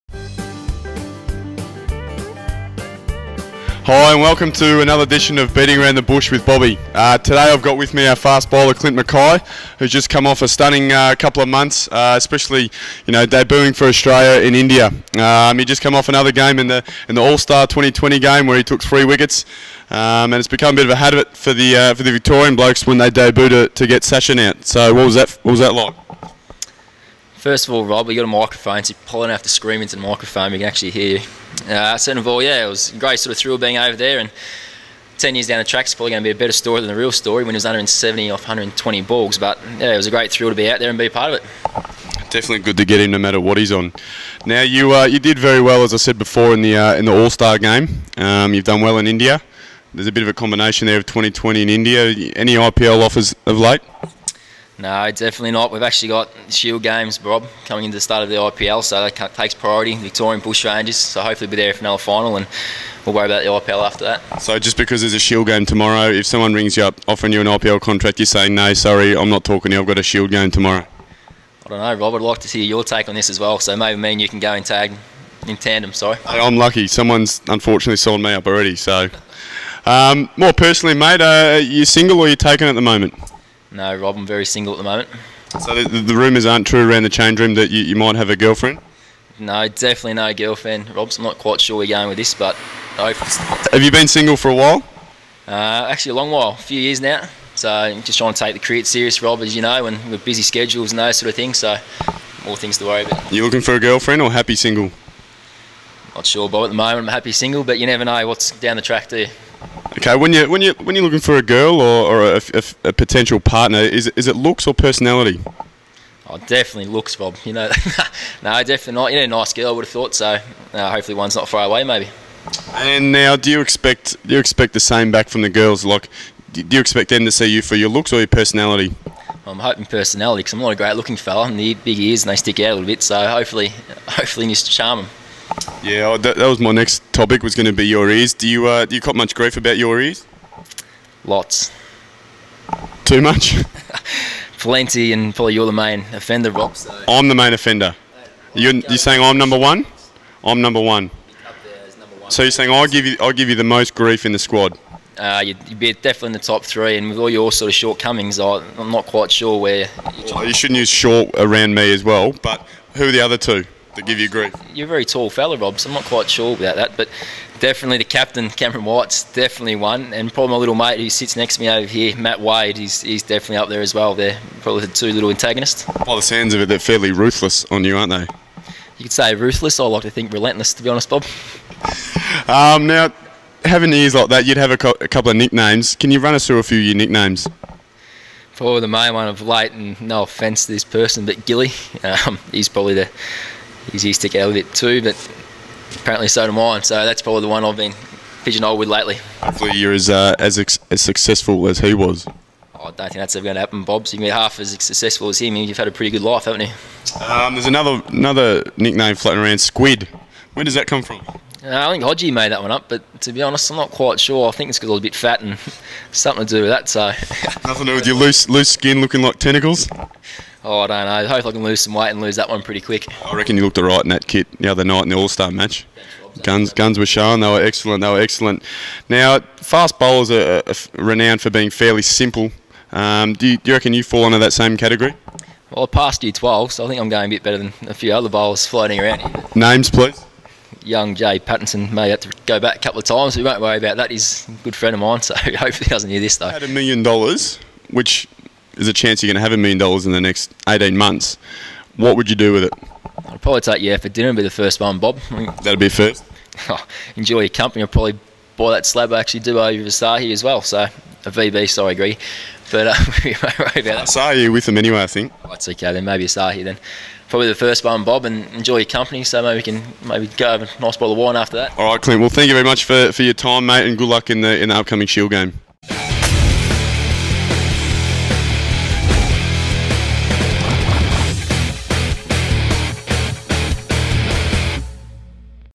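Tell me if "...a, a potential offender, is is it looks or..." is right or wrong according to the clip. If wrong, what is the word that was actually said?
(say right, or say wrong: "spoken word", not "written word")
wrong: "partner", not "offender".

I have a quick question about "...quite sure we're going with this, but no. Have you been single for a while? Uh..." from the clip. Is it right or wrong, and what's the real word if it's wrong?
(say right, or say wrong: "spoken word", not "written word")
right.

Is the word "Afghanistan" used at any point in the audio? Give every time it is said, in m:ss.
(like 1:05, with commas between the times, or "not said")
not said.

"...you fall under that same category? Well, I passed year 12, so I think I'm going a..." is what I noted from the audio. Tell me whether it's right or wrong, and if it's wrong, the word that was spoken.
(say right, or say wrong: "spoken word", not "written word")
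right.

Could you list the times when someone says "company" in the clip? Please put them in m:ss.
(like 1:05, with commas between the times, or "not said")
4:17, 4:28.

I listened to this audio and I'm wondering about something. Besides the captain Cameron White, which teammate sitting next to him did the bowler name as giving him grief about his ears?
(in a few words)
Matt Wade.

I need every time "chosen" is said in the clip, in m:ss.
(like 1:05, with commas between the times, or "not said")
not said.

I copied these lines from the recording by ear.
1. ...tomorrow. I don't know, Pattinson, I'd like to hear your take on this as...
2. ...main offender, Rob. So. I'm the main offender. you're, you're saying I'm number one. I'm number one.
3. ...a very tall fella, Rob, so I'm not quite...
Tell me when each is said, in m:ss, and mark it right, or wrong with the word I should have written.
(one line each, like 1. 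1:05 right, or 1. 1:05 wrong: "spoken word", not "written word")
1. 1:10 wrong: "Rob", not "Pattinson"
2. 2:25 right
3. 2:44 right.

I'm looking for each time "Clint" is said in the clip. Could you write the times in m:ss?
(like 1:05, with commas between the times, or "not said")
0:08, 4:32.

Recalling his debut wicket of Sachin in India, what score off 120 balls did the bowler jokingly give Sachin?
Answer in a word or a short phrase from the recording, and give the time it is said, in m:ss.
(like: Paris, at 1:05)
170, at 0:37.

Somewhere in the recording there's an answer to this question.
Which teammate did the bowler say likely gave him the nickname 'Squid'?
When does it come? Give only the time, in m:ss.
3:32.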